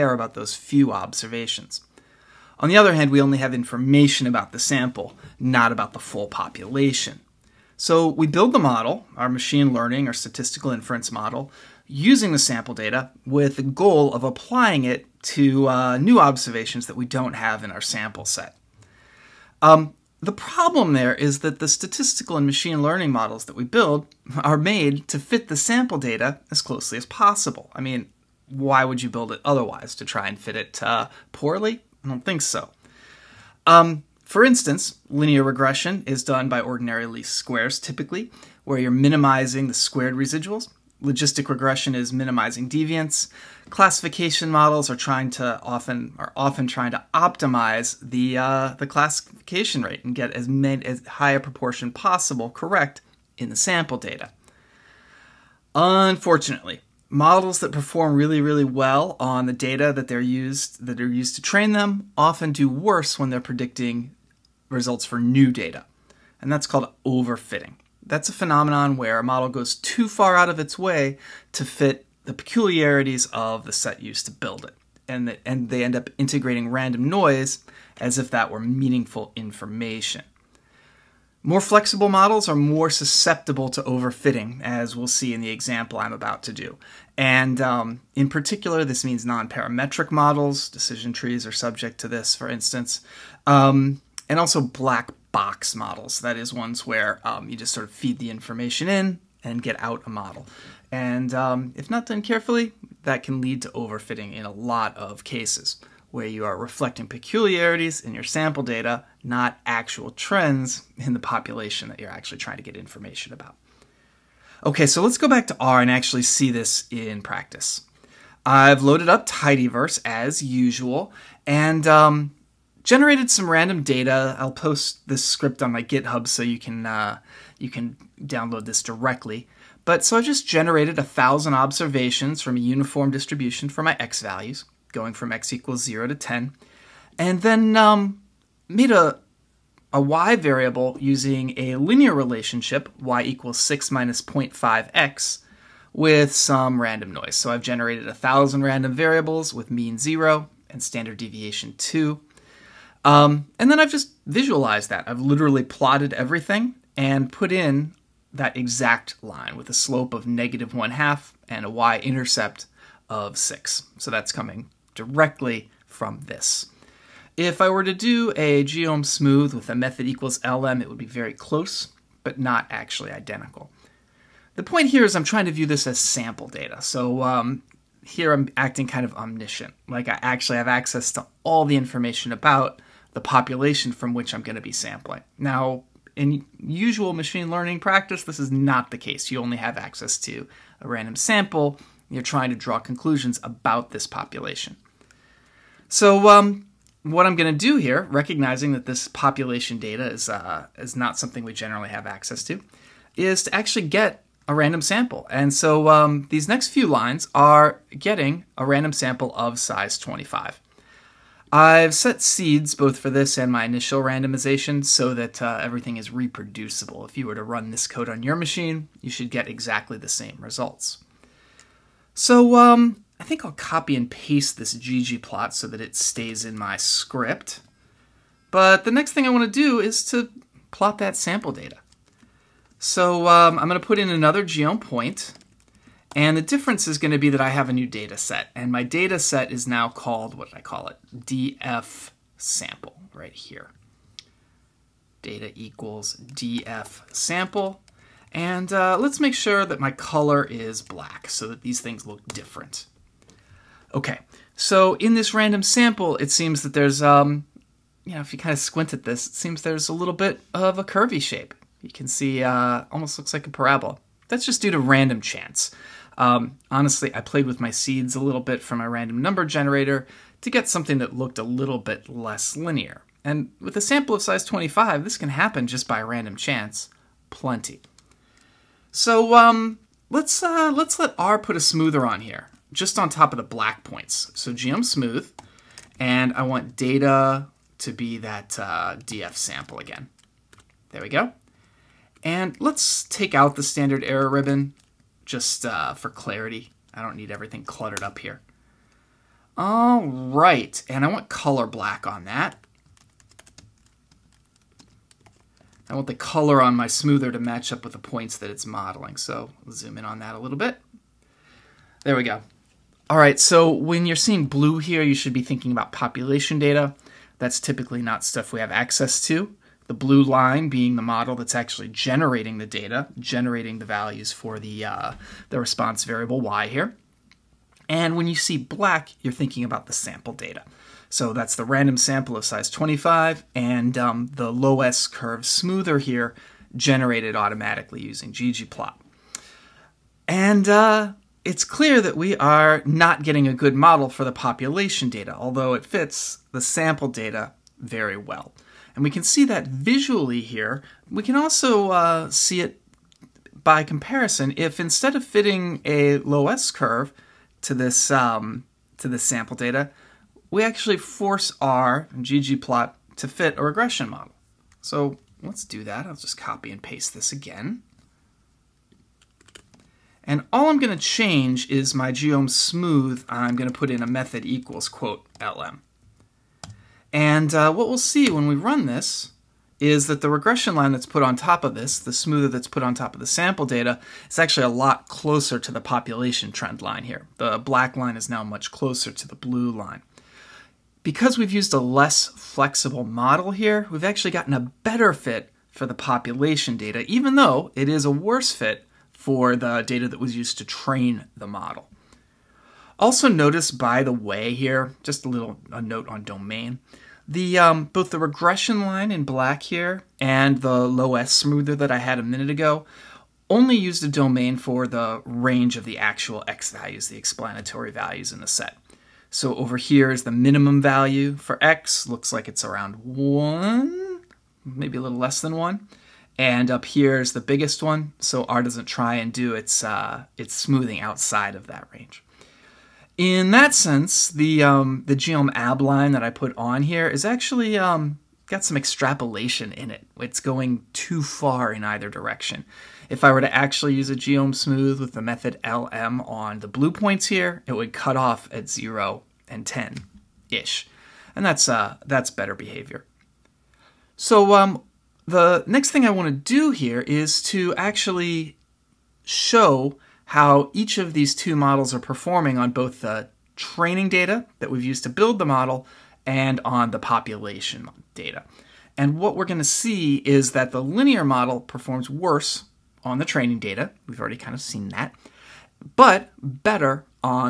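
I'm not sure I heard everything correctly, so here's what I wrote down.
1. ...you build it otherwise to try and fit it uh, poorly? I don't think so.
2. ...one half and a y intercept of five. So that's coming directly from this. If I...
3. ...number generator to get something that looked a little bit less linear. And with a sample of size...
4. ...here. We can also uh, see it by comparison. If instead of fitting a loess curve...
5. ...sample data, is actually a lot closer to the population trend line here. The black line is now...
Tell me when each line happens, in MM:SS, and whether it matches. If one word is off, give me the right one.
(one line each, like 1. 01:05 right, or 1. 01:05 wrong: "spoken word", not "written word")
1. 00:29 right
2. 02:40 wrong: "six", not "five"
3. 04:29 right
4. 05:50 right
5. 06:23 right.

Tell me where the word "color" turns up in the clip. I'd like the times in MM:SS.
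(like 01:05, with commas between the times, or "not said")
04:09, 05:01, 05:06.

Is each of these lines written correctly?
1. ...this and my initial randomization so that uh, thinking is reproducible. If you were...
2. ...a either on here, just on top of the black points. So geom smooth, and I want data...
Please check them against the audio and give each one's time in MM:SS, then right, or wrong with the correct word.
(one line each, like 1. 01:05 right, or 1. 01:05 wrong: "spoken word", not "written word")
1. 03:33 wrong: "everything", not "thinking"
2. 04:41 wrong: "smoother", not "either".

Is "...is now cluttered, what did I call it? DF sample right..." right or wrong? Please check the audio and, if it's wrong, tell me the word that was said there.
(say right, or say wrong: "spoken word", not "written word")
wrong: "called", not "cluttered".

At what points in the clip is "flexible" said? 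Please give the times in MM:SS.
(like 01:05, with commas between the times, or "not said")
01:21, 06:32.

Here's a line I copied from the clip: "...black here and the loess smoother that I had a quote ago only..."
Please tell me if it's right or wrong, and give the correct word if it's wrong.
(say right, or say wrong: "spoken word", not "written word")
wrong: "minute", not "quote".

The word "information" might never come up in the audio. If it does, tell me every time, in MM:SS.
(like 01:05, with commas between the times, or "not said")
00:03, 01:19, 01:38, 01:52, 03:01.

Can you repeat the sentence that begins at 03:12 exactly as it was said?
You're trying to draw conclusions about this population.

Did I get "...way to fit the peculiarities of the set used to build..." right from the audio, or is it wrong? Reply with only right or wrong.
right.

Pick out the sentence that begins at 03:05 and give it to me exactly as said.
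Now, in usual machine learning practice, this is not the case.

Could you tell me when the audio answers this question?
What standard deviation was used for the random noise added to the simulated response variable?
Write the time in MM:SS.
02:31.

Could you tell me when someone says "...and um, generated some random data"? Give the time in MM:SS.
02:01.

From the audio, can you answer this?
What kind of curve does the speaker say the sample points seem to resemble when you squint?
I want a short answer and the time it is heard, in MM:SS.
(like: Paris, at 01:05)
parabola, at 04:23.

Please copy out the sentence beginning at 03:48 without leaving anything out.
But the next thing I want to do is to plot that sample data.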